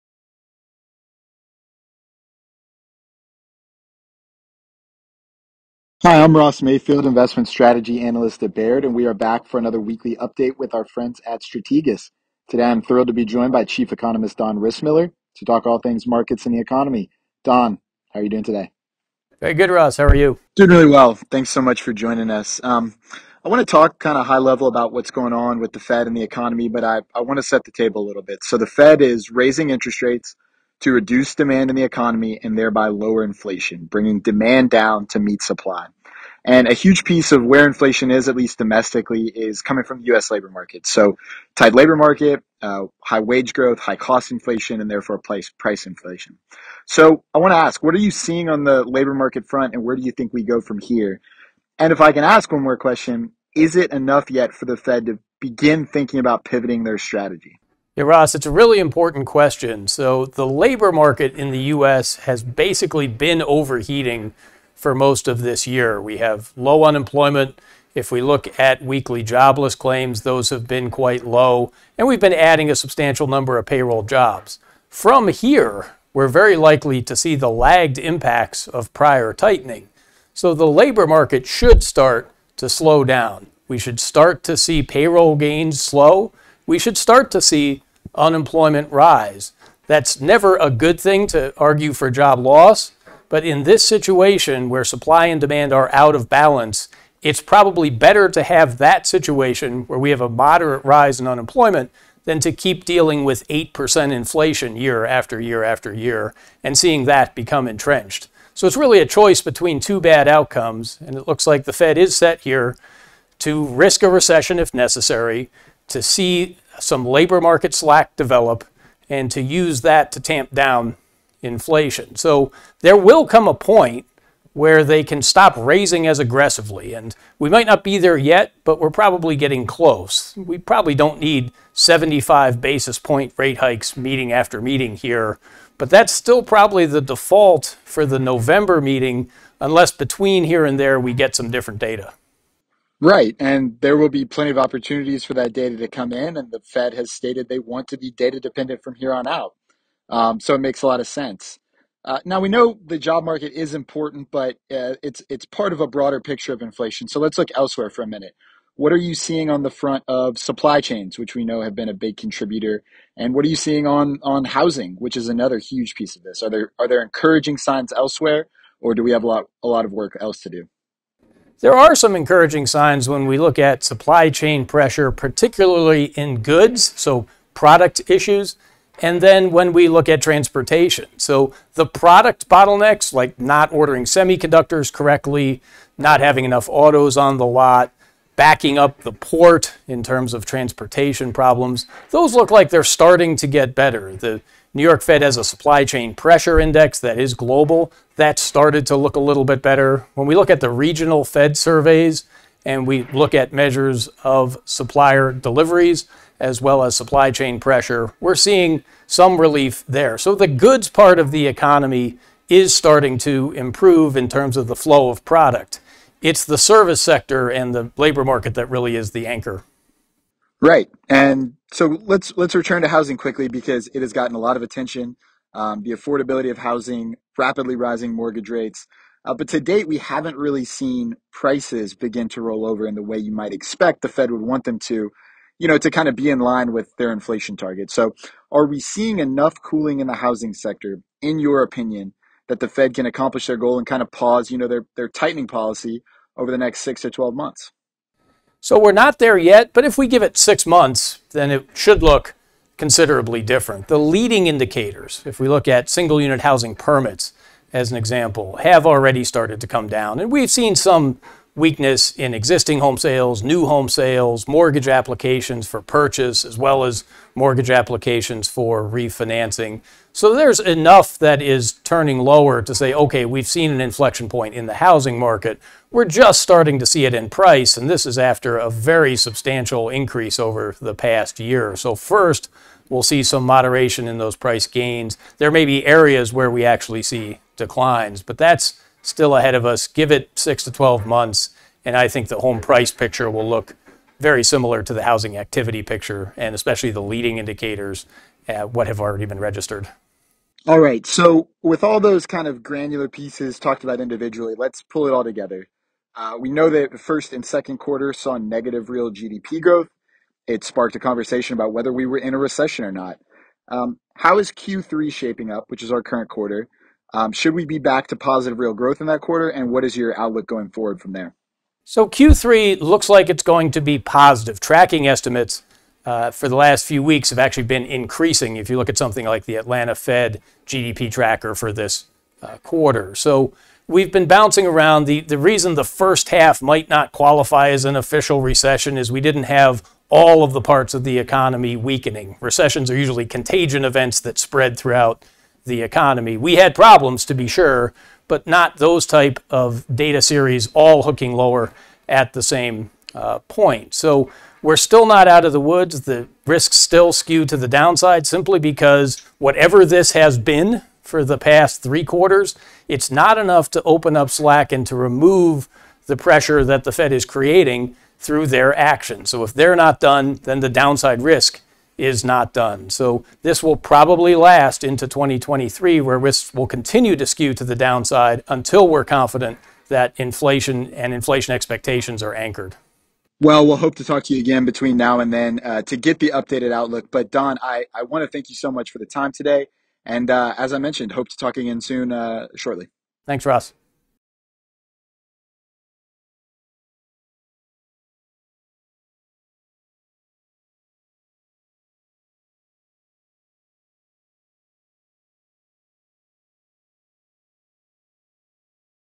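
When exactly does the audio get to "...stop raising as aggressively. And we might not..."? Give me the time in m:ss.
2:05.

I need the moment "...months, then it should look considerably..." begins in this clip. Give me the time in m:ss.
4:10.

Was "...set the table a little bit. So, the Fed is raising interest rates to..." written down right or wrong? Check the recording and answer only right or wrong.
right.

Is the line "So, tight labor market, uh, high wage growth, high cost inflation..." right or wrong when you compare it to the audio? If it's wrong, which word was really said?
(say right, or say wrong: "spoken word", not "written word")
right.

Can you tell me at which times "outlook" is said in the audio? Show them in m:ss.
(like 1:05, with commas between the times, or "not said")
5:20, 6:26.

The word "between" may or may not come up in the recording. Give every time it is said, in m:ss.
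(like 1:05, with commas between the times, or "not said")
1:49, 2:19, 6:24.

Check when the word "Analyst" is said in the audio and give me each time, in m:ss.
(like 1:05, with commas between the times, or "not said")
0:08.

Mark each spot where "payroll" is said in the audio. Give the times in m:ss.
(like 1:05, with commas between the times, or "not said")
1:13, 1:24.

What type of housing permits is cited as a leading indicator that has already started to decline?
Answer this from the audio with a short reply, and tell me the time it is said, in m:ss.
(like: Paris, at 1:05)
Single unit housing permits, at 4:15.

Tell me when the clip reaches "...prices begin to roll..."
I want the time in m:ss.
3:51.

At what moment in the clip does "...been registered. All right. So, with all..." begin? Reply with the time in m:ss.
4:59.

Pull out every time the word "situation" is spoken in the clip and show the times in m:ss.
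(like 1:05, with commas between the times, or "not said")
1:33, 1:39.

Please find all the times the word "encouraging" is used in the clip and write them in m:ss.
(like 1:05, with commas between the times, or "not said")
2:47, 2:52.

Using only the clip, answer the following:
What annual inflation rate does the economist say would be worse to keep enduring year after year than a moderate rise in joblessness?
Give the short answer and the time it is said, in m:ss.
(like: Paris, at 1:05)
8%, at 1:43.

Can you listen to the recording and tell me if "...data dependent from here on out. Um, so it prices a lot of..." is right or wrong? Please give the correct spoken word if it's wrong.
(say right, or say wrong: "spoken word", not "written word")
wrong: "makes", not "prices".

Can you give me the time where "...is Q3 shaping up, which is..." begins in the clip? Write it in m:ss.
5:14.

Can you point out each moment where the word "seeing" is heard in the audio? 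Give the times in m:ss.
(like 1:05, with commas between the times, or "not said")
0:48, 1:46, 2:39, 2:43, 3:28, 3:58.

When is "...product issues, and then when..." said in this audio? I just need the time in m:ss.
2:57.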